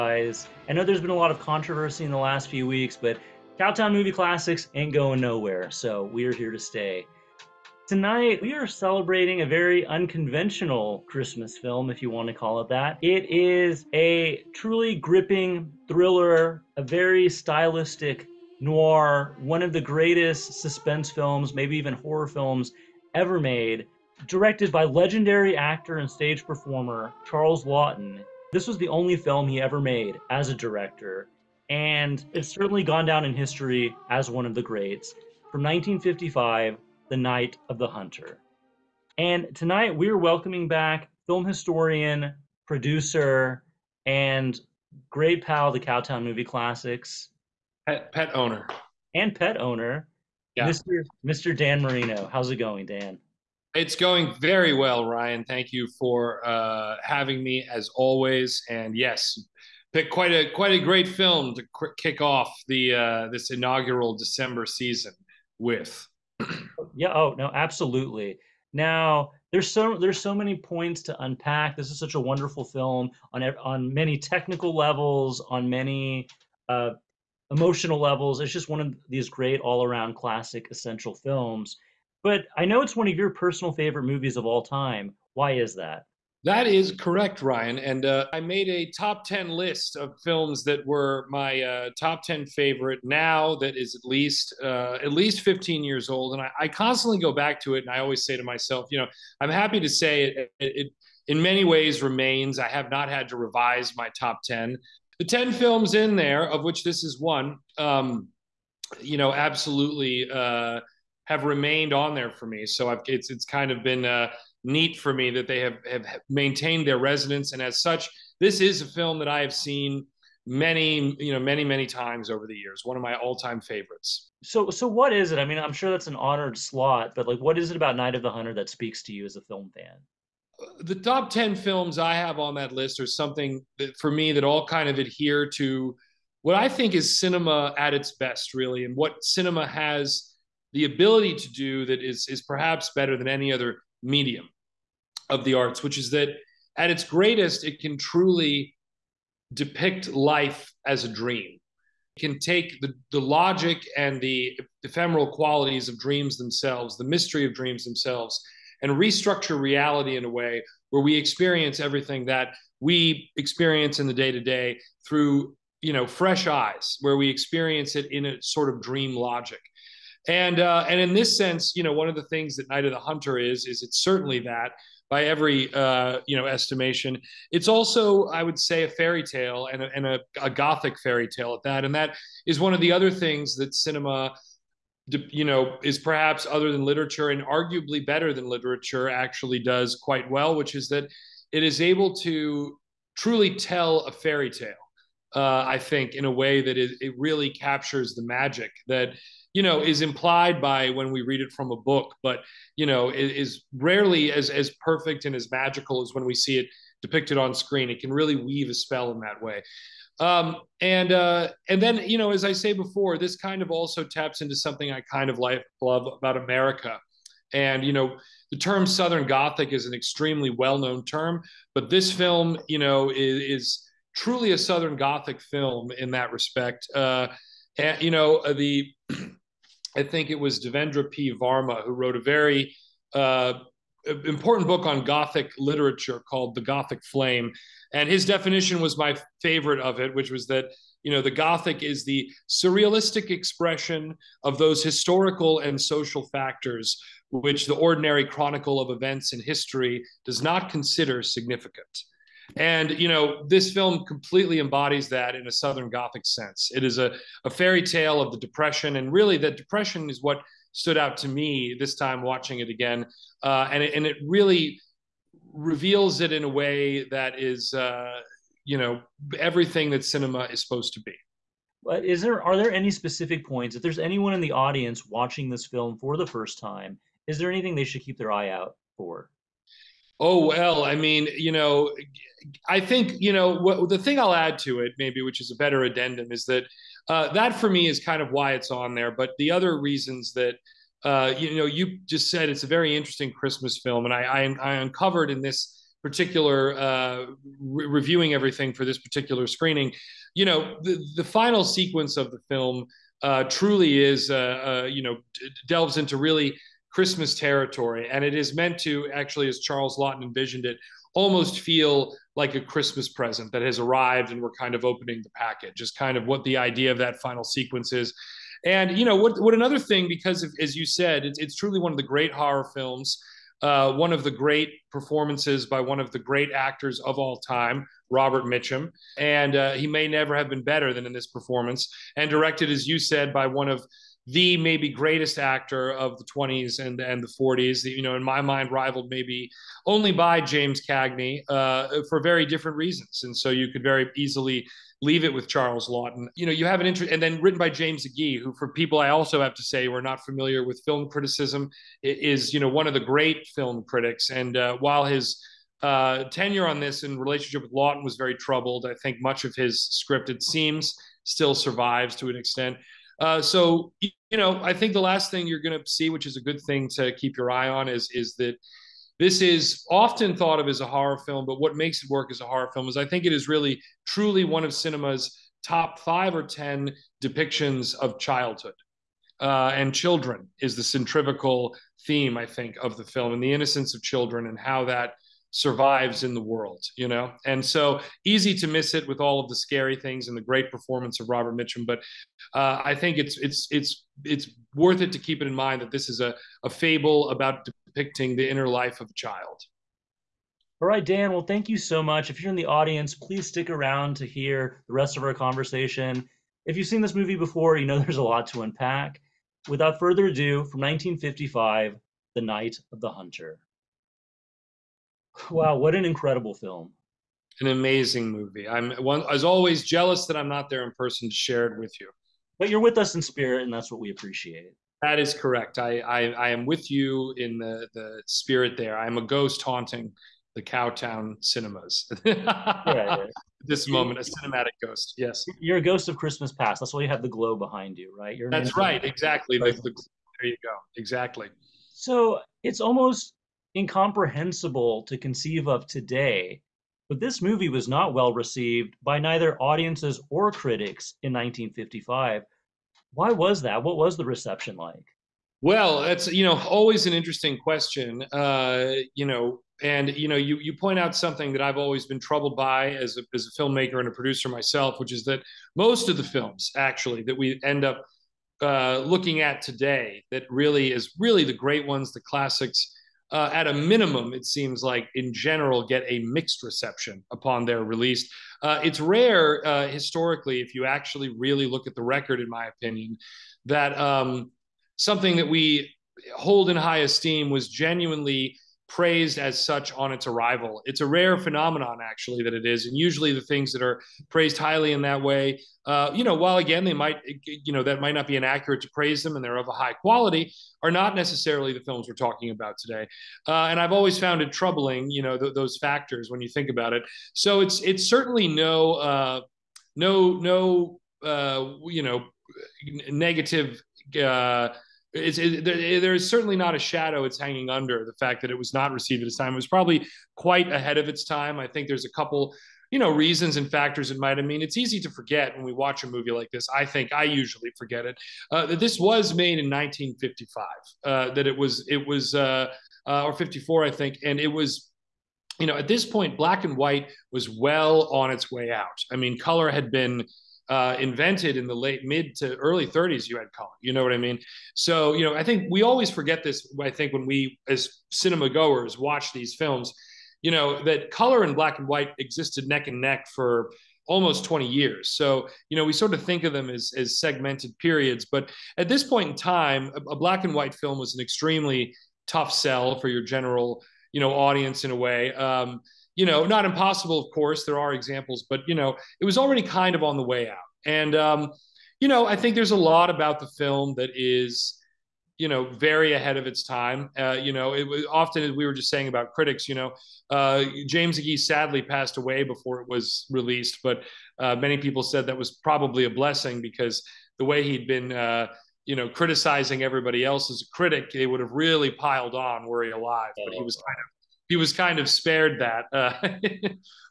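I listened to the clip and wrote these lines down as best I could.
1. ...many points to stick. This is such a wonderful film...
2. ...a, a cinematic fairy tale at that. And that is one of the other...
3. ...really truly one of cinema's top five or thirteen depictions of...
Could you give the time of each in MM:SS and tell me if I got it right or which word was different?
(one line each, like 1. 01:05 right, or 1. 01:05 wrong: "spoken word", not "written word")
1. 01:10 wrong: "unpack", not "stick"
2. 03:00 wrong: "gothic", not "cinematic"
3. 06:13 wrong: "ten", not "thirteen".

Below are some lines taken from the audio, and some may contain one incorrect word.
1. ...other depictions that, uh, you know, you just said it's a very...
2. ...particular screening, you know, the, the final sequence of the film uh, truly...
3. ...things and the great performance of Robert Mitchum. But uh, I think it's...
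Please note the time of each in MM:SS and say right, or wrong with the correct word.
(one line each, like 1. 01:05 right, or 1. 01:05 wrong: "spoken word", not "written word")
1. 04:49 wrong: "reasons", not "depictions"
2. 04:58 right
3. 06:29 right.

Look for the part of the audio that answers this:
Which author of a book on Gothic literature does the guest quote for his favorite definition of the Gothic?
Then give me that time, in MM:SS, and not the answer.
03:50.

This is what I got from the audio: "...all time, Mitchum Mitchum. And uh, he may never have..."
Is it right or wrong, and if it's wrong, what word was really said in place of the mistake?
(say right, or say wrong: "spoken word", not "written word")
wrong: "Robert", not "Mitchum".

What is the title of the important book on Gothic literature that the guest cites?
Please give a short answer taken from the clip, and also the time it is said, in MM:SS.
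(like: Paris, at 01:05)
The Gothic Flame, at 03:56.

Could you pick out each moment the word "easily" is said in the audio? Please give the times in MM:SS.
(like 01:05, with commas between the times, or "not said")
05:44.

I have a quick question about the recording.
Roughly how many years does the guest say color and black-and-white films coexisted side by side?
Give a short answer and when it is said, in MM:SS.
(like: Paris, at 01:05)
20 years, at 09:14.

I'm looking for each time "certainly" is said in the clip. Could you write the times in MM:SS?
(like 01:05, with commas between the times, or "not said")
00:32, 02:53, 08:28, 08:36.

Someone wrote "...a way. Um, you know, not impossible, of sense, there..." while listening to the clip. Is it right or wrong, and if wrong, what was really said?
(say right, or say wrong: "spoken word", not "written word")
wrong: "course", not "sense".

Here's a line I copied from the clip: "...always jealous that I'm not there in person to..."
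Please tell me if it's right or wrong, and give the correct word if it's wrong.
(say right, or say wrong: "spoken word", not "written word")
right.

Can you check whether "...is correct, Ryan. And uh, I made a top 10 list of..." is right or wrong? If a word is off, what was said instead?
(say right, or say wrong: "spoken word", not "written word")
right.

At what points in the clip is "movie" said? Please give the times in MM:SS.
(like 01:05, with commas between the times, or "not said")
00:03, 00:46, 01:24, 06:47, 06:58, 07:27, 08:46.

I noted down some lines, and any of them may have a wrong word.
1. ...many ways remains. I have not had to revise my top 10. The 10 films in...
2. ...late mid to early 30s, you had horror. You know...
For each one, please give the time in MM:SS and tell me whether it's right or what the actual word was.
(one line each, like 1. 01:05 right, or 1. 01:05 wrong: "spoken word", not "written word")
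1. 01:41 right
2. 09:01 wrong: "color", not "horror".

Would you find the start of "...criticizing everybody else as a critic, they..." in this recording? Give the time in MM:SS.
09:49.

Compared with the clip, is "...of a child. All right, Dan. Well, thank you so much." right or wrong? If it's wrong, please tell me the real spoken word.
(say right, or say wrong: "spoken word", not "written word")
right.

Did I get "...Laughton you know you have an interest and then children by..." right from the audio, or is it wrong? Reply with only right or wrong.
wrong.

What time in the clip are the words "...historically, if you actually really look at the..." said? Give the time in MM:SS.
07:59.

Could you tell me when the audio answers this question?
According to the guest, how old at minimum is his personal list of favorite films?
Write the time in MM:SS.
01:35.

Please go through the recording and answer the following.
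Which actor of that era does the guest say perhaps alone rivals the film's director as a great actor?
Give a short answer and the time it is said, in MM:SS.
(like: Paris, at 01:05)
James Cagney, at 05:40.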